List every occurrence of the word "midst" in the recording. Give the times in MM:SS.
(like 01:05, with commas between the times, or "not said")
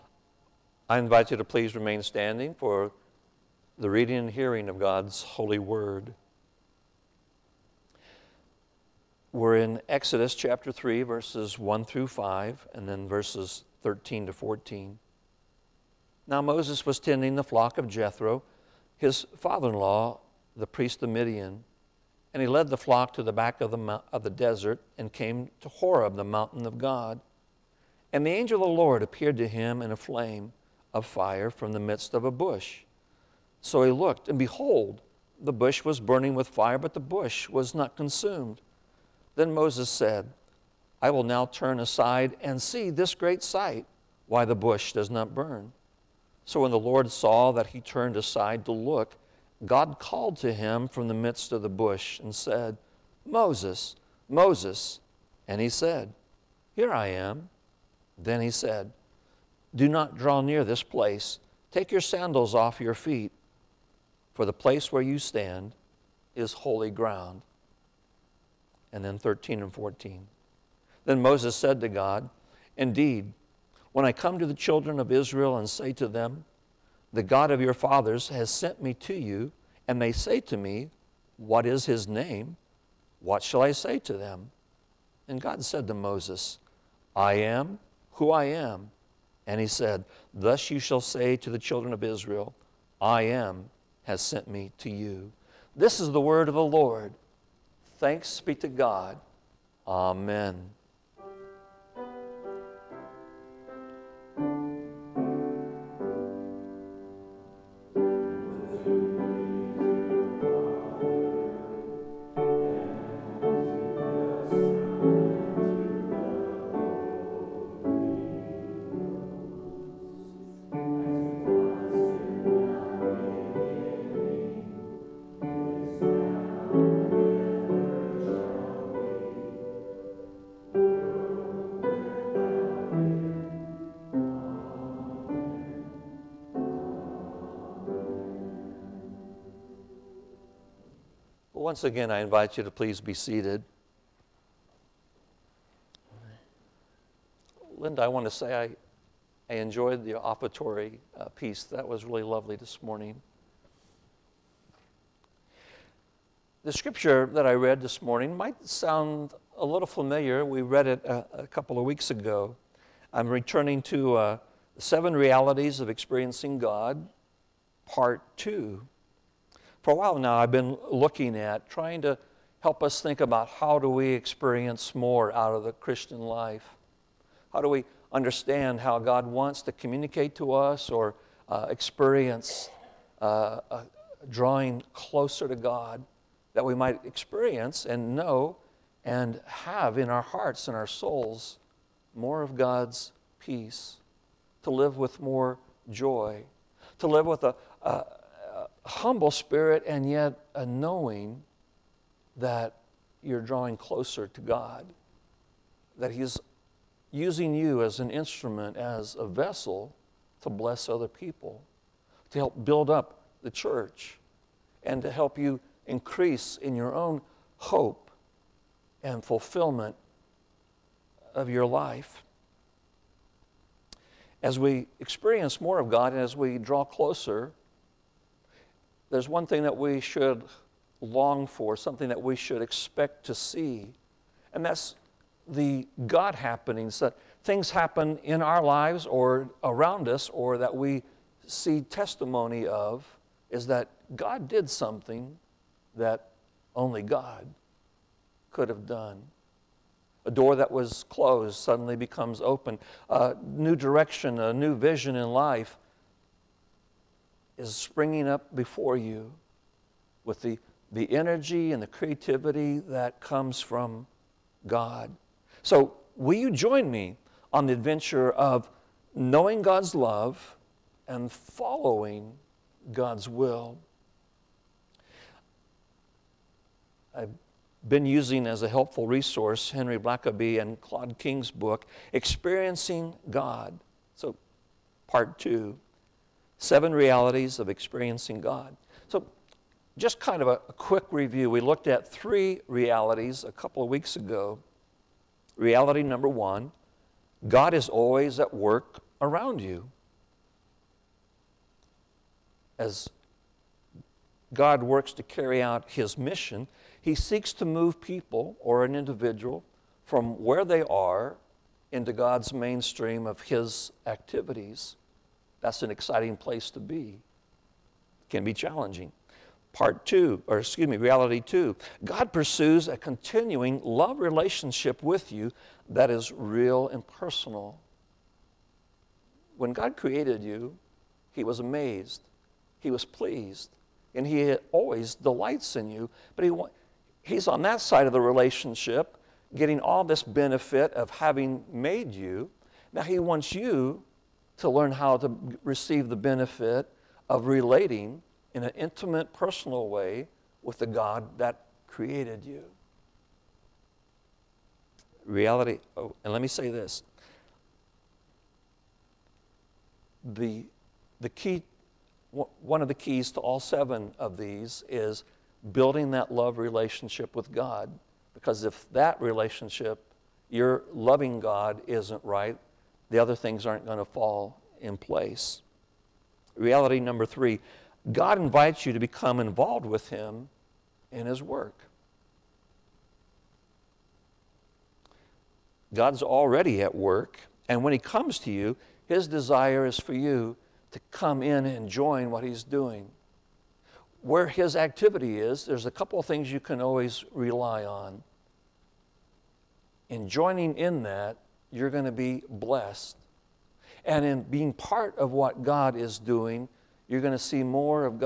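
00:31, 00:51.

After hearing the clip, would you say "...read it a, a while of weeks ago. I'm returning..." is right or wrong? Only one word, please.
wrong.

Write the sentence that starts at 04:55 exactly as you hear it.
Reality number one God is always at work around you.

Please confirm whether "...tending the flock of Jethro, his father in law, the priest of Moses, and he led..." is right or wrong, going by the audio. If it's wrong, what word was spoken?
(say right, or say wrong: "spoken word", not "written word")
wrong: "Midian", not "Moses".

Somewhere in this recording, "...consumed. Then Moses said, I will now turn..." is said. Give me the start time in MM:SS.
00:37.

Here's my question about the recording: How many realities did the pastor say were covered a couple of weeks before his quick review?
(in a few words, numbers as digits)
3.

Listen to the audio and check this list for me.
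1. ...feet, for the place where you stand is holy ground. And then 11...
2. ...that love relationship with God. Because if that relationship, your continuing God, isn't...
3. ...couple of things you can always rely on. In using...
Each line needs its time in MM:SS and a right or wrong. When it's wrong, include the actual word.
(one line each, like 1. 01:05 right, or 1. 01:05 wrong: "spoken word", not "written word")
1. 01:02 wrong: "13", not "11"
2. 06:06 wrong: "loving", not "continuing"
3. 06:35 wrong: "joining", not "using".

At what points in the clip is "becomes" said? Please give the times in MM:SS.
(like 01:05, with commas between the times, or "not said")
04:11, 06:18.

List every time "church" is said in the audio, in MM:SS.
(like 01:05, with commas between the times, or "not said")
03:33.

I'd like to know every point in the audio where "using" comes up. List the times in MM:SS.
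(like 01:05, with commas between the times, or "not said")
03:27, 04:38.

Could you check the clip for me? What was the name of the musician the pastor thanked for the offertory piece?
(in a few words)
Linda.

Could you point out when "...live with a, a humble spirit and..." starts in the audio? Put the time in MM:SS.
03:17.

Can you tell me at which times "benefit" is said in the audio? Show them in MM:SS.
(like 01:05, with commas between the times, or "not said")
05:40, 05:46.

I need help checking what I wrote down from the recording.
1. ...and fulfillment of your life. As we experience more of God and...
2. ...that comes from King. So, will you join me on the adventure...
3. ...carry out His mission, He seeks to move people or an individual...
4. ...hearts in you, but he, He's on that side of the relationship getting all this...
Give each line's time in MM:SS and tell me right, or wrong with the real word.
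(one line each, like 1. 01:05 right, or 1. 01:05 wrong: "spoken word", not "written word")
1. 03:39 right
2. 04:22 wrong: "God", not "King"
3. 05:05 right
4. 05:35 wrong: "delights", not "hearts".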